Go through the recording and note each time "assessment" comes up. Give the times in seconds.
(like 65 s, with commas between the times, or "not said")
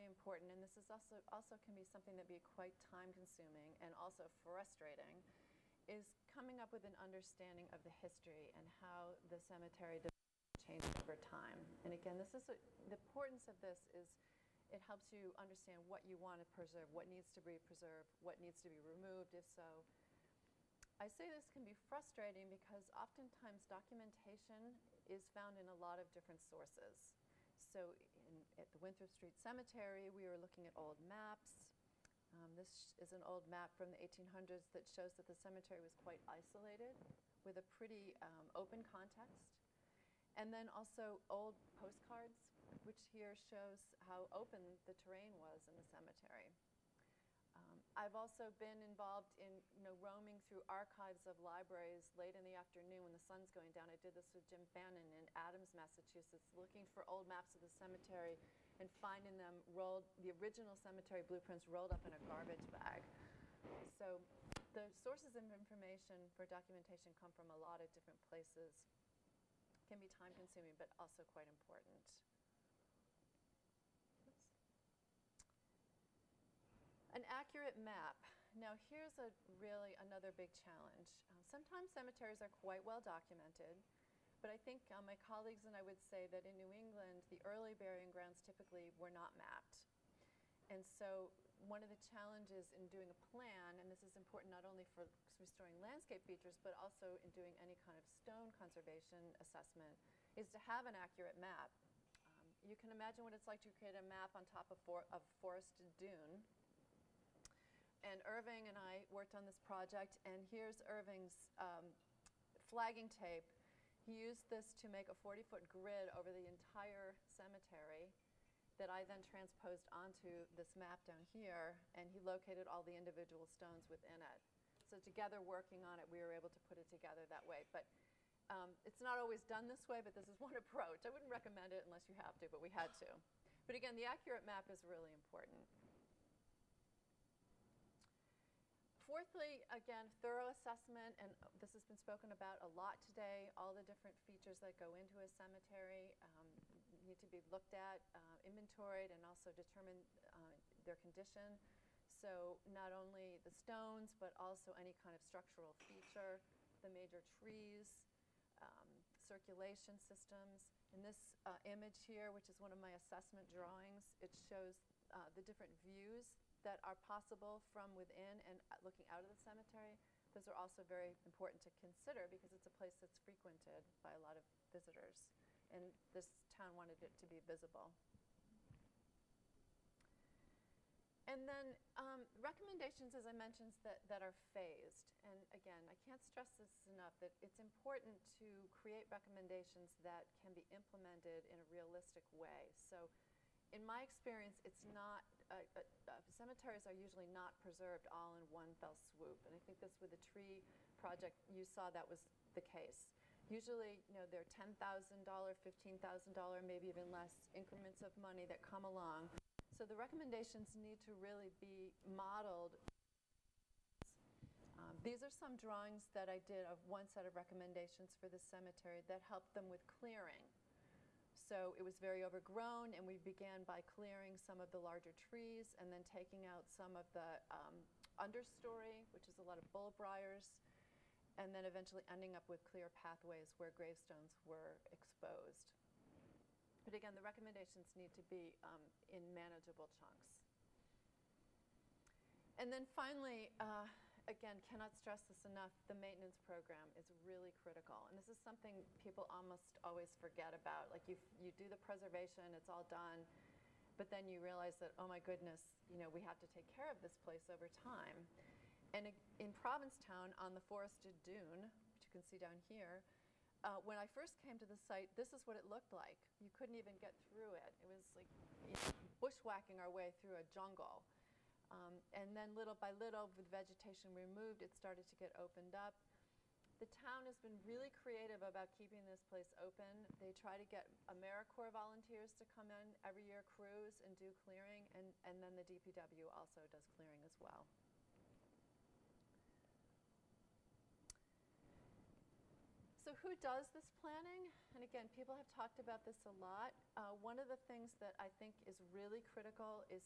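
99 s, 140 s, 162 s.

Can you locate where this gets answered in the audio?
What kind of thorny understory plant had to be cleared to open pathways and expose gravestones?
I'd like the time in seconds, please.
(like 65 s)
229 s.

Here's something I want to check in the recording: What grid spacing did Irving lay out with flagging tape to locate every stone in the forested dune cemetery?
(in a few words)
40-foot.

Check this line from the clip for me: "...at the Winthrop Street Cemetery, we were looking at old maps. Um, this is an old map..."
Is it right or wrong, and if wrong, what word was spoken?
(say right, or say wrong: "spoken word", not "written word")
right.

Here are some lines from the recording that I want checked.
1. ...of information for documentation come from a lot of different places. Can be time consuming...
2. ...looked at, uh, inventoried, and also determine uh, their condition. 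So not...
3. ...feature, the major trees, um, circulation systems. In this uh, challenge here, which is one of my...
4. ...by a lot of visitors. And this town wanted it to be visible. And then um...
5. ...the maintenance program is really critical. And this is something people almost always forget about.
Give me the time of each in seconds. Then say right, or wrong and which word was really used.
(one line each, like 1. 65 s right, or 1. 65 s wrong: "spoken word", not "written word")
1. 65 s right
2. 147 s right
3. 155 s wrong: "image", not "challenge"
4. 174 s right
5. 245 s right.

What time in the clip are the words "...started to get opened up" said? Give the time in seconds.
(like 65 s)
274 s.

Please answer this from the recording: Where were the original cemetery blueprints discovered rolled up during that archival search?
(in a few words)
In a garbage bag.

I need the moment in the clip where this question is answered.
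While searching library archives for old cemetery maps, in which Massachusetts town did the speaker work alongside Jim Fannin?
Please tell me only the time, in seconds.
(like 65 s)
55 s.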